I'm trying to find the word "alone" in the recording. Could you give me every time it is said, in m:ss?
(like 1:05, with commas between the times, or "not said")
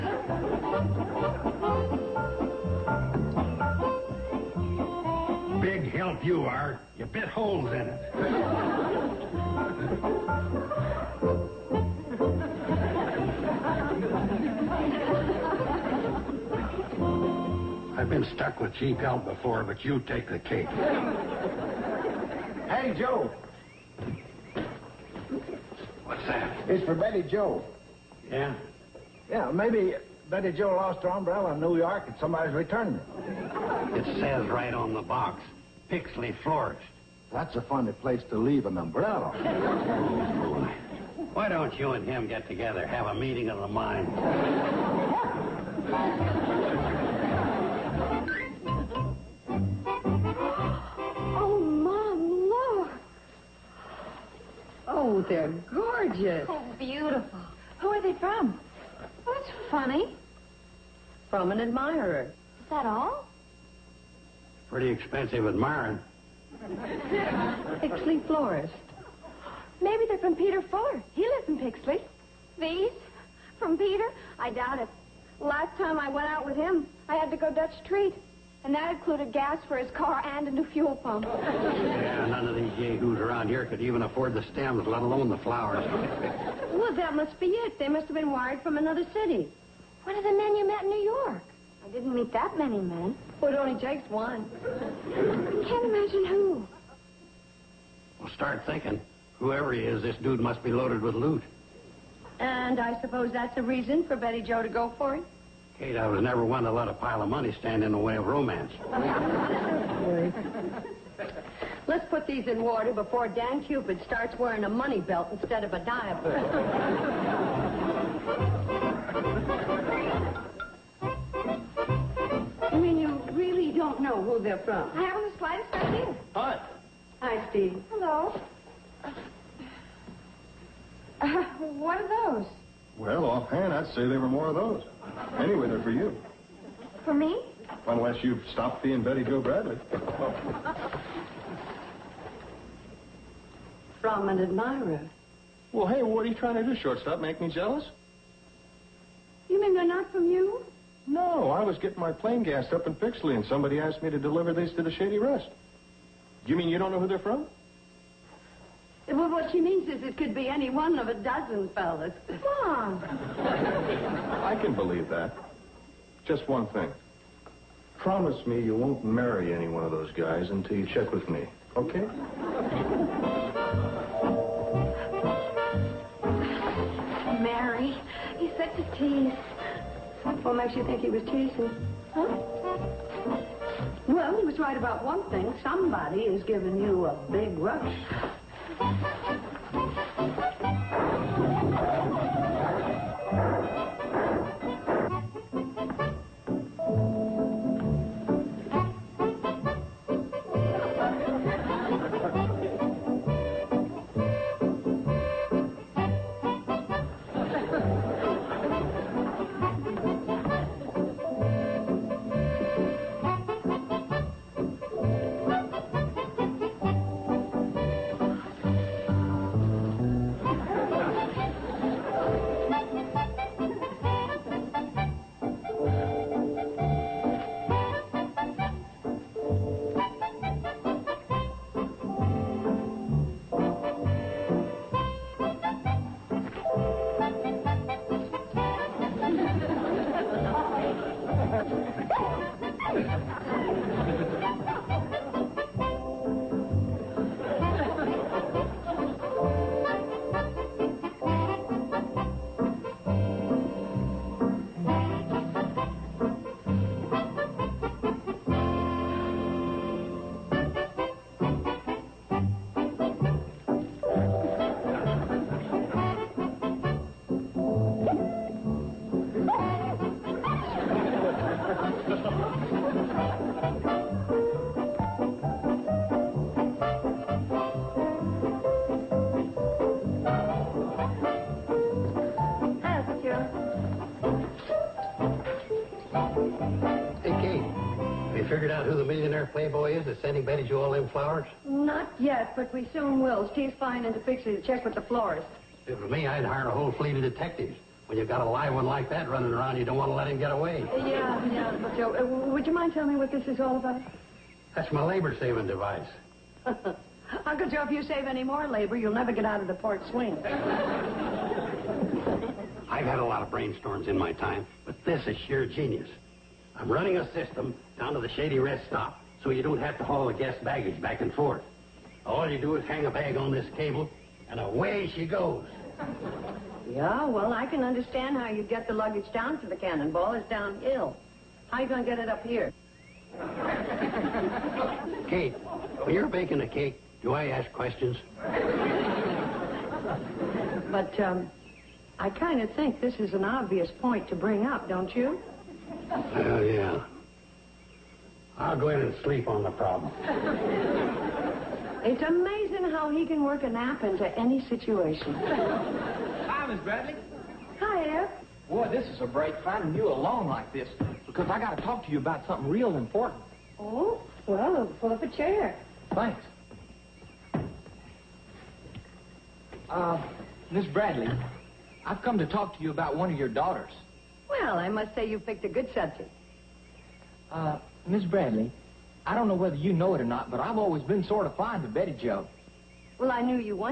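1:25, 6:00.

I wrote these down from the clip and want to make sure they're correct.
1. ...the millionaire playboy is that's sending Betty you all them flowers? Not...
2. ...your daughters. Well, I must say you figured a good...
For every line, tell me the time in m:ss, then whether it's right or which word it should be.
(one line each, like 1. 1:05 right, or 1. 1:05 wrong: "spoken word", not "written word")
1. 4:48 right
2. 6:13 wrong: "picked", not "figured".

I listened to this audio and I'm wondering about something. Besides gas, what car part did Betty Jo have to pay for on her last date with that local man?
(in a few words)
a new fuel pump.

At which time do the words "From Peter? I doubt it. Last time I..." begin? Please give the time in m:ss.
1:13.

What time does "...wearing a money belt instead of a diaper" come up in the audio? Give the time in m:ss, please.
1:54.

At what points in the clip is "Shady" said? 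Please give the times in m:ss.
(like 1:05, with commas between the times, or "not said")
2:34, 5:18.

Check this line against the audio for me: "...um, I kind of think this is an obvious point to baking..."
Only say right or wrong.
wrong.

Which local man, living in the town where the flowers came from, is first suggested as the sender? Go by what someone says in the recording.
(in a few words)
Peter Fuller.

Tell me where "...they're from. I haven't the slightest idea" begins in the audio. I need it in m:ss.
2:04.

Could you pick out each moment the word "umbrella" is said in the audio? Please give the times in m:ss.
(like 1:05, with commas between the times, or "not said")
0:31, 0:38.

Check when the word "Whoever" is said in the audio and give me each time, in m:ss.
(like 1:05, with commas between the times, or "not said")
1:39.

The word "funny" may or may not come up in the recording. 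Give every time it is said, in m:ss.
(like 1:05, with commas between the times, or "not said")
0:37, 0:59.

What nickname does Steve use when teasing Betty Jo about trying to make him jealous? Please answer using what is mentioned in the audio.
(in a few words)
shortstop.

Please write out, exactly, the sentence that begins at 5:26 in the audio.
Yeah, well, I can understand how you get the luggage down to the cannonball.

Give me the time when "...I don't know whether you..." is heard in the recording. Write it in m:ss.
6:19.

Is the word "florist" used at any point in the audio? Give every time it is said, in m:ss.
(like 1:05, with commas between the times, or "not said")
0:36, 1:08, 4:55.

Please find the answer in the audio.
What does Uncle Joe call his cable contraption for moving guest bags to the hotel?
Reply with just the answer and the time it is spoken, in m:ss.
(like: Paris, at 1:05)
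labor-saving device, at 5:05.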